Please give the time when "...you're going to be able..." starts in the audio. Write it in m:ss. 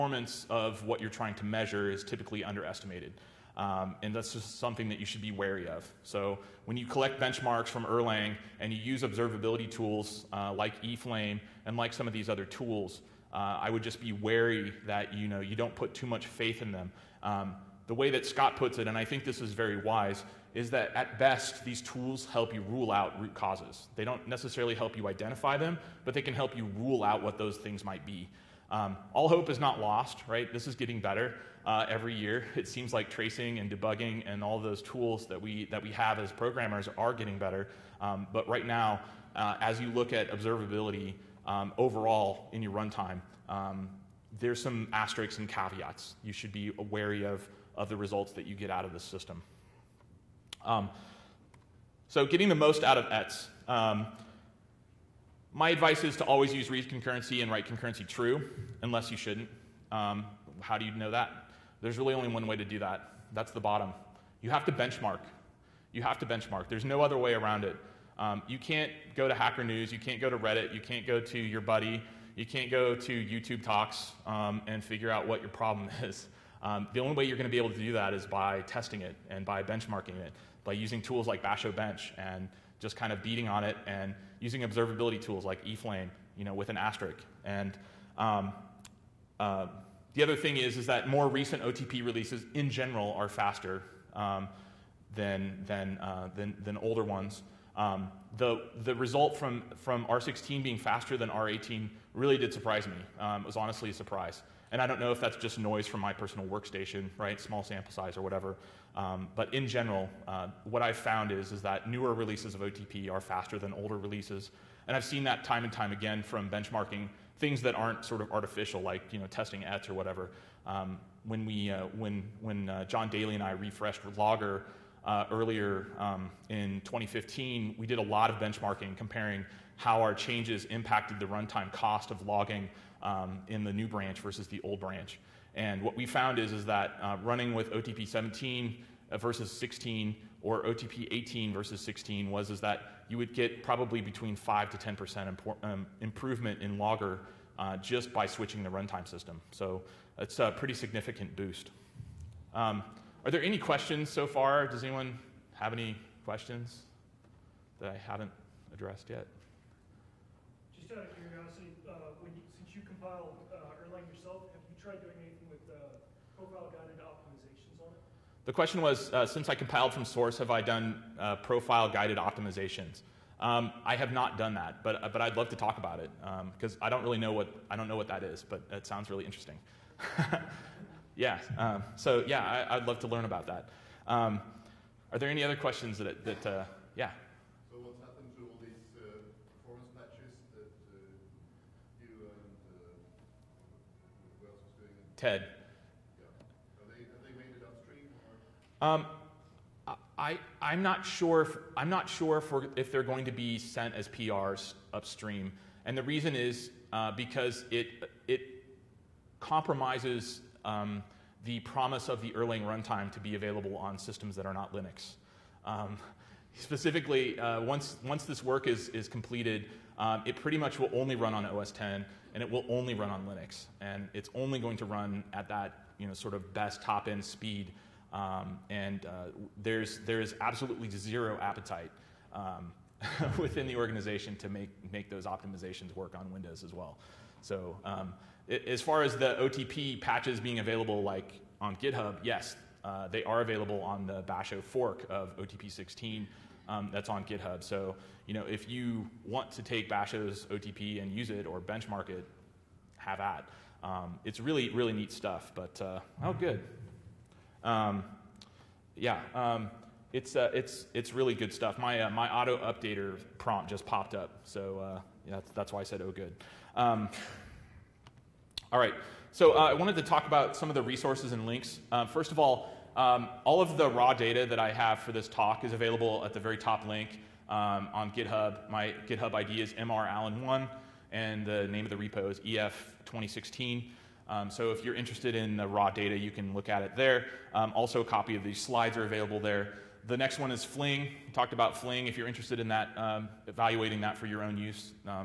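1:17.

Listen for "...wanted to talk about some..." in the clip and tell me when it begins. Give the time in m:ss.
4:29.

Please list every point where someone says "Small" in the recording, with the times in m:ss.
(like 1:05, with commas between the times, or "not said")
1:47.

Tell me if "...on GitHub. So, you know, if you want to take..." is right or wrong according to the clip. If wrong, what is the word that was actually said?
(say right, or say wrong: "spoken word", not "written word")
right.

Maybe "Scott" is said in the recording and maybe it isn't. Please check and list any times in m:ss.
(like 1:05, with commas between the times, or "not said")
0:18.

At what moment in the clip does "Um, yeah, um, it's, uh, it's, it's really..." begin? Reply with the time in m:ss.
4:17.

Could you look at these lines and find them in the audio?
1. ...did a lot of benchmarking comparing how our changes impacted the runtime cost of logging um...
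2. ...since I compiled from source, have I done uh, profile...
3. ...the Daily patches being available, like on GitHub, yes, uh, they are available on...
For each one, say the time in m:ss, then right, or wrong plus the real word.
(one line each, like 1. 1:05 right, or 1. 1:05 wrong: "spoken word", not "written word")
1. 2:07 right
2. 2:49 right
3. 3:59 wrong: "OTP", not "Daily".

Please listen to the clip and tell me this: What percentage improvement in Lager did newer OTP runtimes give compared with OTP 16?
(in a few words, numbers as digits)
5 to 10%.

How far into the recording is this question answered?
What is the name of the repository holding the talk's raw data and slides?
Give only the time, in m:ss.
4:42.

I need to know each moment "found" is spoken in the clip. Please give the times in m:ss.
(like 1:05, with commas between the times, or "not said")
1:50, 2:16.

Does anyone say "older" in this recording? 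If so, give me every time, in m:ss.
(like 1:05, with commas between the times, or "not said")
1:36, 1:53.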